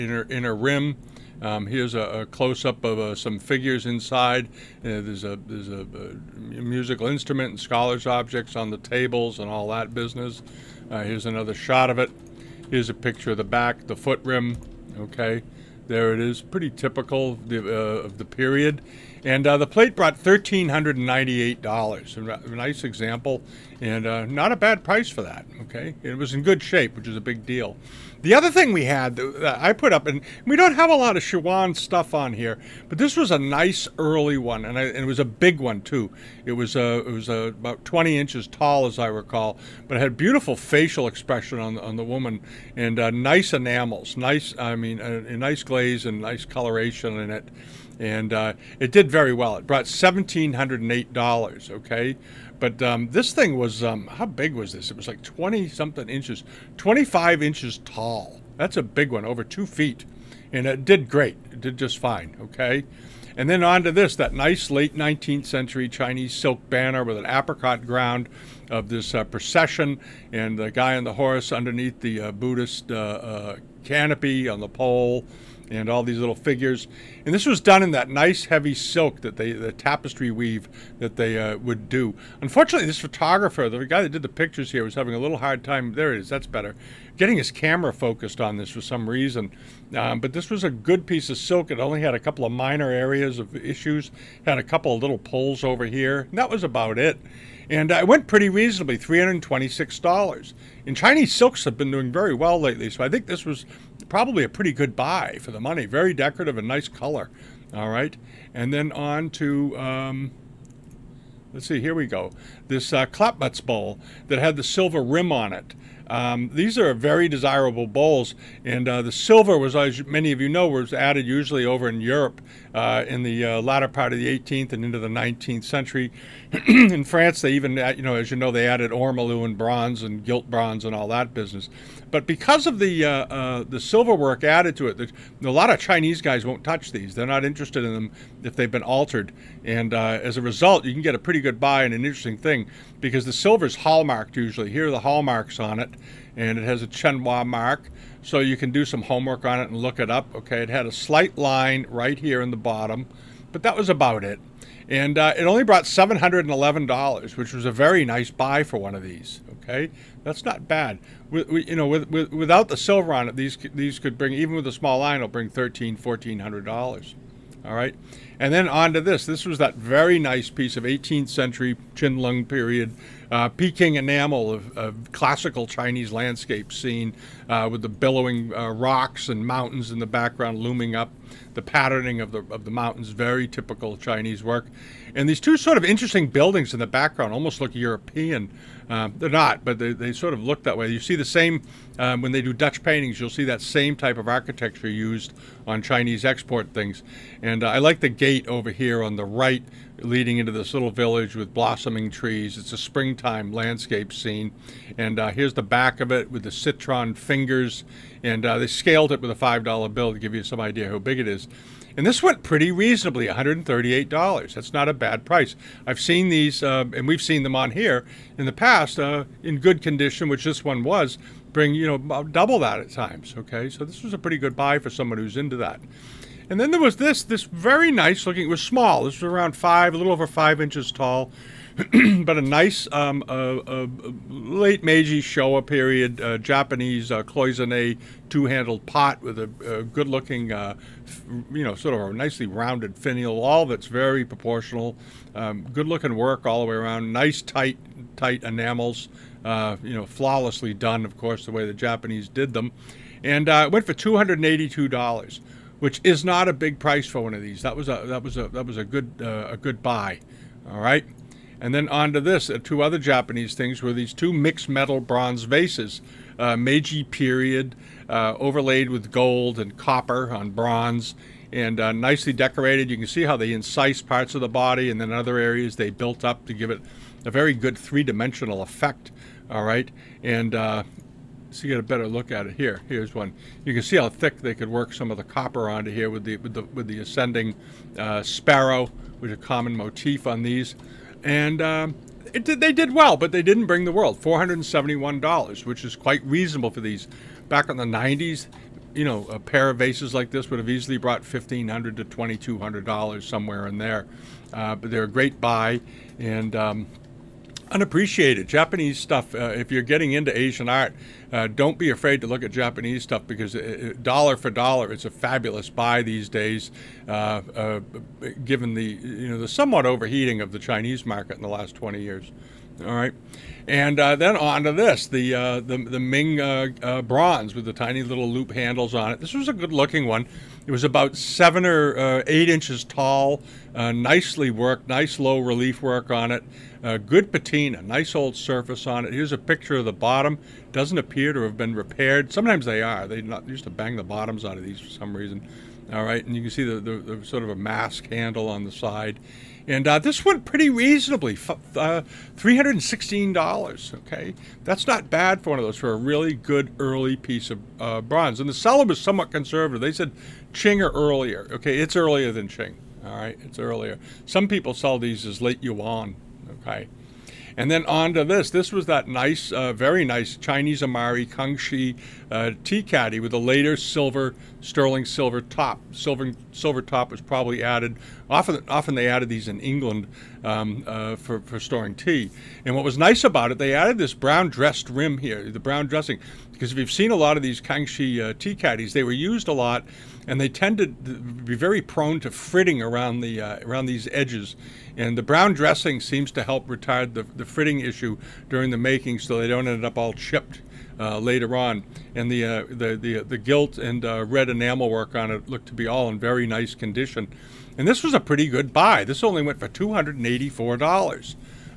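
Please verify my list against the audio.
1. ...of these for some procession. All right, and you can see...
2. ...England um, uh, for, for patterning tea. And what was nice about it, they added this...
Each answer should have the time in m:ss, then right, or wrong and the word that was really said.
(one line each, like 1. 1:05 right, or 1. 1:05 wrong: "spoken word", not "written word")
1. 5:44 wrong: "reason", not "procession"
2. 6:19 wrong: "storing", not "patterning".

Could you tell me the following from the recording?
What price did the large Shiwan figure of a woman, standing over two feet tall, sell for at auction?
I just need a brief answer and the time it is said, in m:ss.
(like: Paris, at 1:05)
$1,708, at 0:49.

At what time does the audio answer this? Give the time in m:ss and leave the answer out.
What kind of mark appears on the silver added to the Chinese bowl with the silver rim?
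2:26.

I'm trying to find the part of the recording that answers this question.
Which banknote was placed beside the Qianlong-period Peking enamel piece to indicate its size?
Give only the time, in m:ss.
3:29.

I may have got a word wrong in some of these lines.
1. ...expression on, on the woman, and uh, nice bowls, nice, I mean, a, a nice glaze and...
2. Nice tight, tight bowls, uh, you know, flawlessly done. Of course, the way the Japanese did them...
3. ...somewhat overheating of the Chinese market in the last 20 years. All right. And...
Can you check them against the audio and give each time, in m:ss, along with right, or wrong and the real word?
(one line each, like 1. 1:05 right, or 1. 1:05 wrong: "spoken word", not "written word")
1. 0:41 wrong: "enamels", not "bowls"
2. 4:07 wrong: "enamels", not "bowls"
3. 5:19 right.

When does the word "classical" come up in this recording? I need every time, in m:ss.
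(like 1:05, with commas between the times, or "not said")
2:55.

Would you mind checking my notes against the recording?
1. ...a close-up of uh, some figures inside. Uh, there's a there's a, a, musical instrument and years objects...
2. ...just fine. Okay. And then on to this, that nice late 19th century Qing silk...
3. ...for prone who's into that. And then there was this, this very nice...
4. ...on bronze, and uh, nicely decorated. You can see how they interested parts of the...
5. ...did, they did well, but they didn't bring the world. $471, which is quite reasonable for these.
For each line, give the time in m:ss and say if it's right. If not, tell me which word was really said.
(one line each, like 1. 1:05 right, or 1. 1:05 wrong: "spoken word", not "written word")
1. 0:01 wrong: "scholars", not "years"
2. 1:01 wrong: "Chinese", not "Qing"
3. 3:44 wrong: "someone", not "prone"
4. 4:30 wrong: "incised", not "interested"
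5. 4:52 right.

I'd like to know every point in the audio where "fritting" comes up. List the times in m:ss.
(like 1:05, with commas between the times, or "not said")
6:32, 6:37.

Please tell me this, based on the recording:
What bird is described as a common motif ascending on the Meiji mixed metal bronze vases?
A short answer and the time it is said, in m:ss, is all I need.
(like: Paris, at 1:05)
sparrow, at 4:48.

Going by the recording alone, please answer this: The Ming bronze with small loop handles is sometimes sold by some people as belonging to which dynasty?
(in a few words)
late Yuan.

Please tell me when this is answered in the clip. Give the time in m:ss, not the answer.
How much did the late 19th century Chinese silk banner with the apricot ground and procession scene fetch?
1:38.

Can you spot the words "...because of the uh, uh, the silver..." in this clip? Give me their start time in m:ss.
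2:12.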